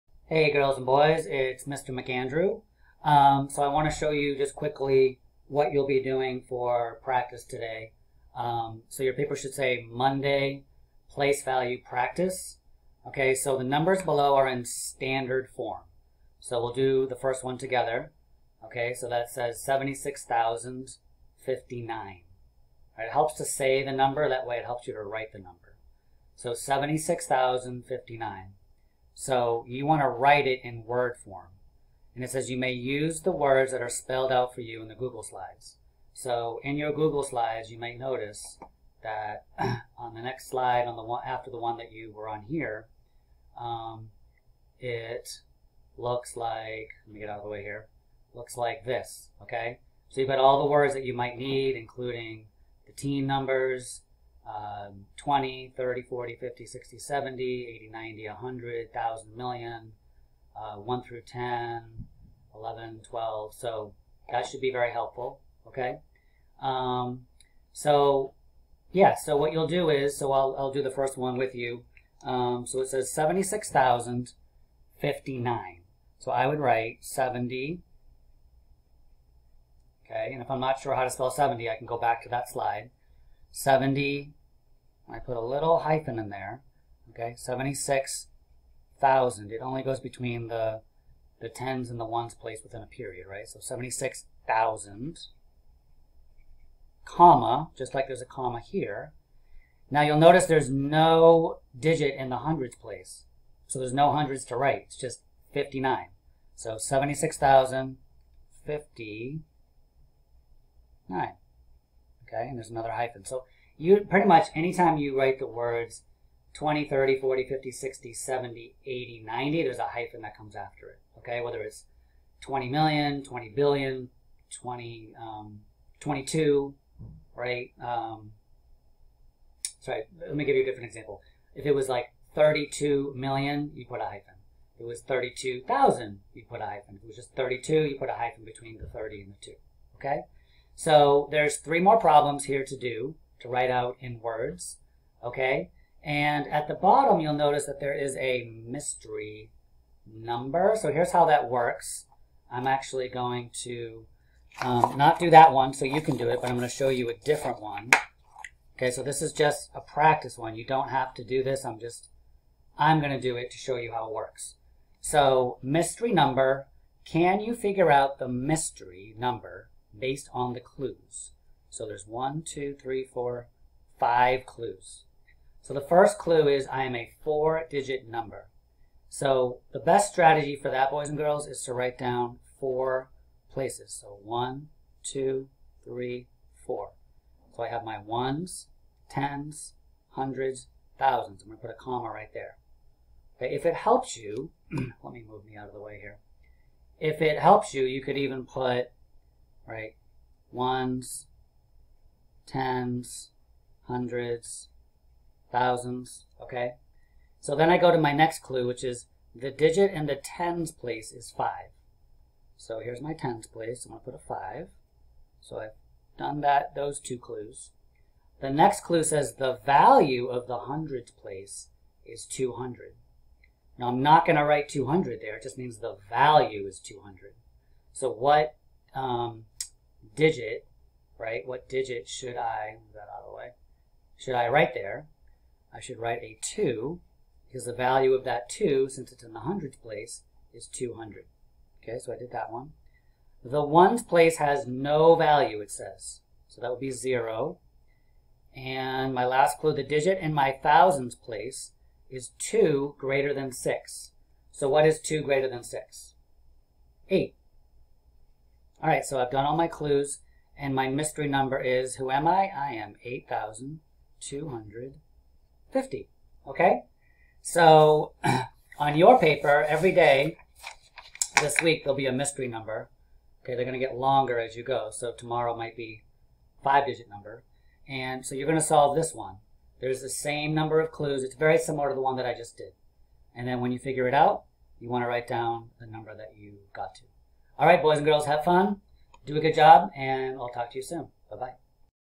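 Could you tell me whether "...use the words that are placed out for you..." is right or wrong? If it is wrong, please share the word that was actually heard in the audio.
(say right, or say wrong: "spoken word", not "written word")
wrong: "spelled", not "placed".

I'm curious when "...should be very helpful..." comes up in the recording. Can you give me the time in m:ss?
1:04.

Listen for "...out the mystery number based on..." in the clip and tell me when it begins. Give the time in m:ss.
2:47.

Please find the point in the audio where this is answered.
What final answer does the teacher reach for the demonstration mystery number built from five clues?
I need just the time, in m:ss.
4:22.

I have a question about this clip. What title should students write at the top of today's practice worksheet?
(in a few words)
Monday place value practice.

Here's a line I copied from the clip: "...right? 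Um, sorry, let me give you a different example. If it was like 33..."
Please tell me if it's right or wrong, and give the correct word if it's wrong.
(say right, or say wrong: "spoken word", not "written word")
wrong: "32", not "33".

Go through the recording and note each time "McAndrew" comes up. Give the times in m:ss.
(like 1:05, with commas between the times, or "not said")
0:01.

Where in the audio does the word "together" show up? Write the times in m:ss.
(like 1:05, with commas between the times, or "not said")
0:17.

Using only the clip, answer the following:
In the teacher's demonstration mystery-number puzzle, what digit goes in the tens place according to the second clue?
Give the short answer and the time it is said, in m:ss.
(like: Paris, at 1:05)
5, at 3:29.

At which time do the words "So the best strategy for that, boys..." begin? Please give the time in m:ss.
2:59.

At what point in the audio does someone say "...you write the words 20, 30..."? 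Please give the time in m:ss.
1:54.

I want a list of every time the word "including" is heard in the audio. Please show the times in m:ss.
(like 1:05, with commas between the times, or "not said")
0:51.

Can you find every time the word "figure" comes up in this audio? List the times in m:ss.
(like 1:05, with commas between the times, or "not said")
2:47, 4:43.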